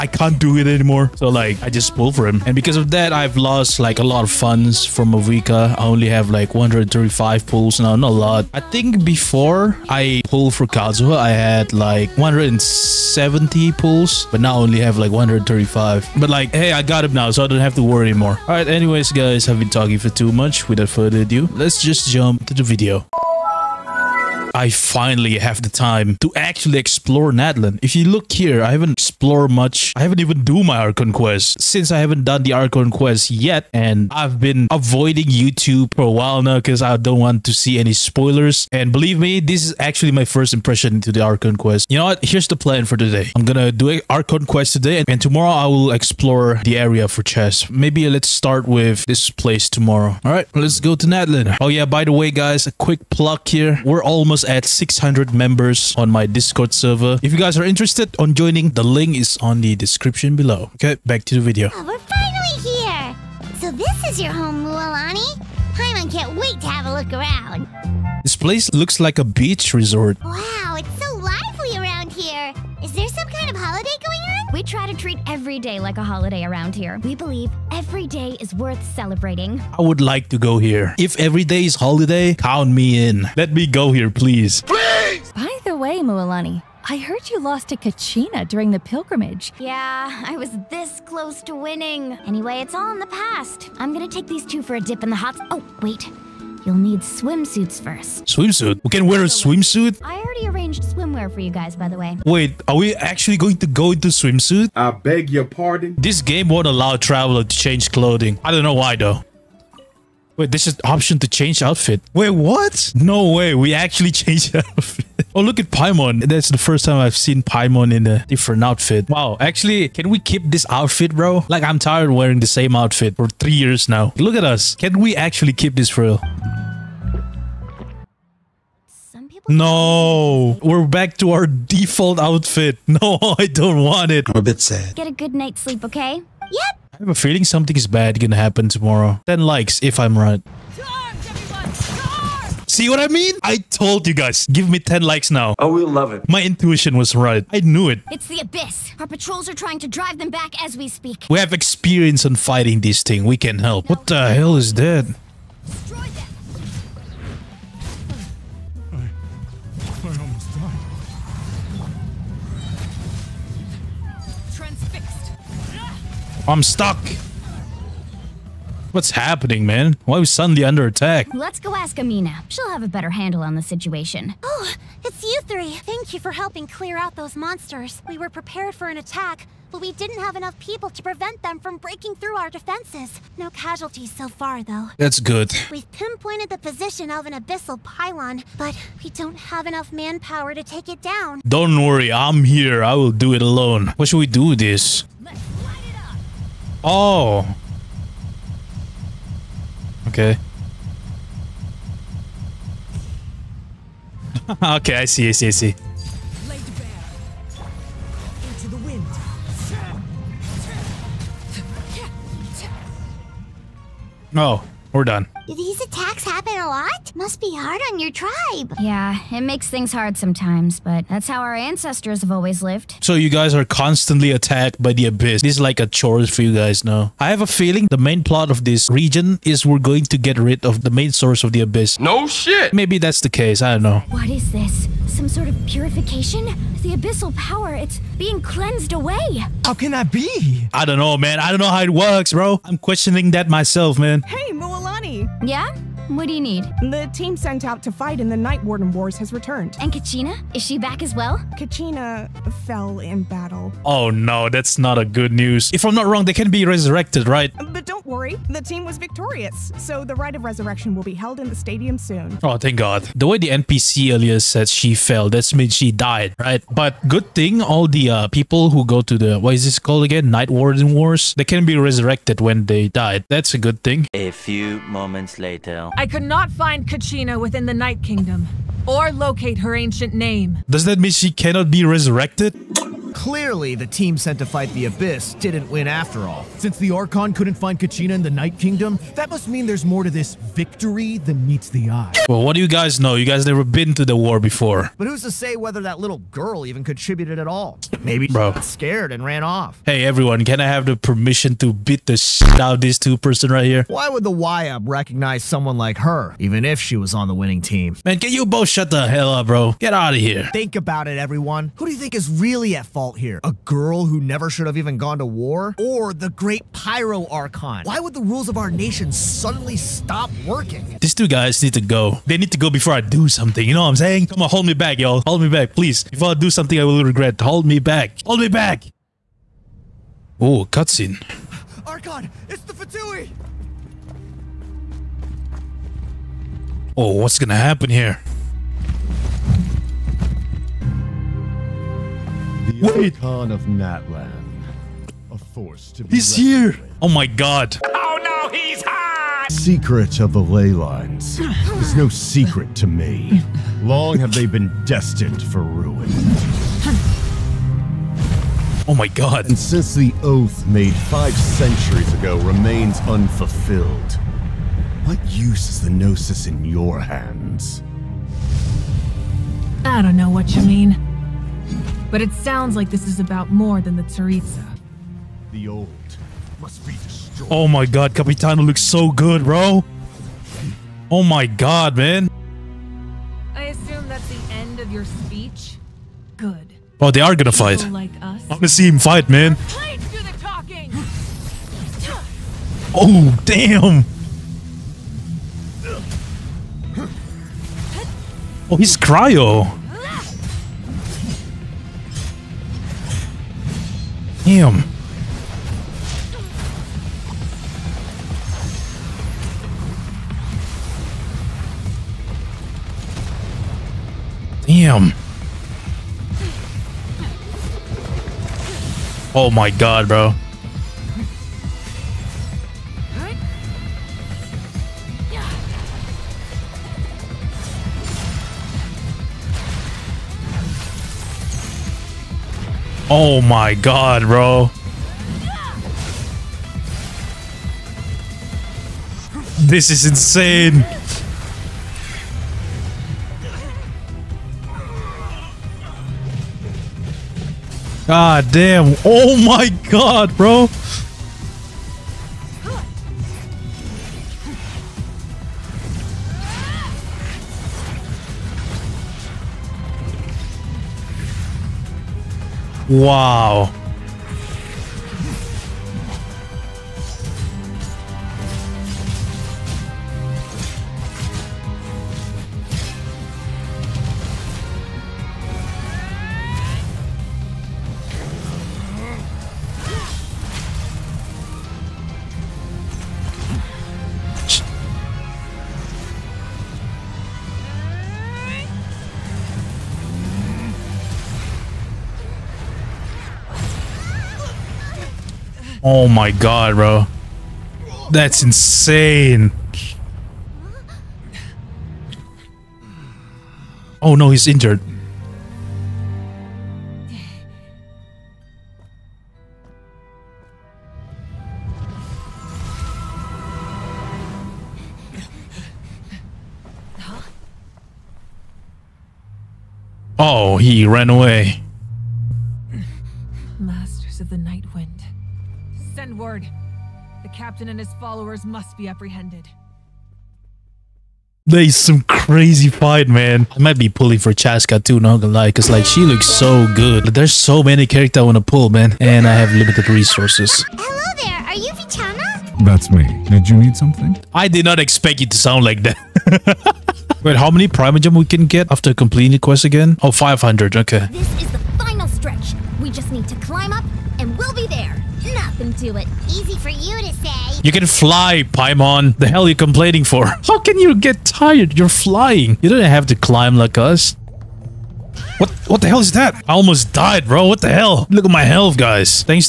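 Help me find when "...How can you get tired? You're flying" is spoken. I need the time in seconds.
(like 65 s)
560 s.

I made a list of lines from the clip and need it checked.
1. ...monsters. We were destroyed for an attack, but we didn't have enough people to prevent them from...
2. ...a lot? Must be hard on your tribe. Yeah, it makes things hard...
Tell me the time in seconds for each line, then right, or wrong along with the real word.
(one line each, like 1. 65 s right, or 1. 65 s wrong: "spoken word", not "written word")
1. 177 s wrong: "prepared", not "destroyed"
2. 216 s right.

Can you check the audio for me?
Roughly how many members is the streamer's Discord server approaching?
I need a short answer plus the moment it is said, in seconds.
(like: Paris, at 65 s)
600, at 54 s.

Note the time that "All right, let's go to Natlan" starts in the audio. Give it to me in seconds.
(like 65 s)
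50 s.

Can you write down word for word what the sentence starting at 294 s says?
But who's to say whether that little girl even contributed at all?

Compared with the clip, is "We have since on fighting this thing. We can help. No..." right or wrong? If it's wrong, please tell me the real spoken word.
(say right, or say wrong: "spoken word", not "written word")
wrong: "experience", not "since".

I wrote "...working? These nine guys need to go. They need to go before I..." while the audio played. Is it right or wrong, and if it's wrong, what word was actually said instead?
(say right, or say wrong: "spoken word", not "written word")
wrong: "two", not "nine".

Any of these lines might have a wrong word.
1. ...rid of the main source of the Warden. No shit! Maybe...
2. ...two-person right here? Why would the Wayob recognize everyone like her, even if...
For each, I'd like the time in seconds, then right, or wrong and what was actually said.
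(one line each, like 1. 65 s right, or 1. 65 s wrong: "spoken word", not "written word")
1. 230 s wrong: "Abyss", not "Warden"
2. 302 s wrong: "someone", not "everyone".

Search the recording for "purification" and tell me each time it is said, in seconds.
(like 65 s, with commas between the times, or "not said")
235 s.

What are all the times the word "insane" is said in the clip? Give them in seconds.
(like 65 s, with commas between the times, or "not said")
440 s, 498 s.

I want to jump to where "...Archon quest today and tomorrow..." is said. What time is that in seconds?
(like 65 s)
44 s.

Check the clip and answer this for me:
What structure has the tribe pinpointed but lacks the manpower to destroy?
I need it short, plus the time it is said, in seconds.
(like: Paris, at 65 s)
Abyssal pylon, at 187 s.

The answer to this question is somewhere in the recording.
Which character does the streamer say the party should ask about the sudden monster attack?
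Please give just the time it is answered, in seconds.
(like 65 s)
171 s.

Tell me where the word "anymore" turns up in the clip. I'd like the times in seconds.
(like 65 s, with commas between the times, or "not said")
0 s, 18 s.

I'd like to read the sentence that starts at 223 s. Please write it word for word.
So you guys are constantly attacked by the Abyss.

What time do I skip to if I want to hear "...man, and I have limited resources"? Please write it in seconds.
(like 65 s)
538 s.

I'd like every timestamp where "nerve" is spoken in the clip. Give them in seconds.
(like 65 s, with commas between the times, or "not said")
not said.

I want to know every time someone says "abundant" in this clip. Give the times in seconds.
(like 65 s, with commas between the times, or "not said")
not said.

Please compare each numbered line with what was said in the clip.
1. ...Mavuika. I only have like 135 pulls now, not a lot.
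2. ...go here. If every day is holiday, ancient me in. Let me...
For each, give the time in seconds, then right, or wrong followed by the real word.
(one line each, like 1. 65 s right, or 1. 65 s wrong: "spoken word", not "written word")
1. 5 s right
2. 80 s wrong: "count", not "ancient".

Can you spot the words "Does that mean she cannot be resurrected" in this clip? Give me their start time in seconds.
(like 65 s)
280 s.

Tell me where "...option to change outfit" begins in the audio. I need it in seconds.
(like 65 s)
110 s.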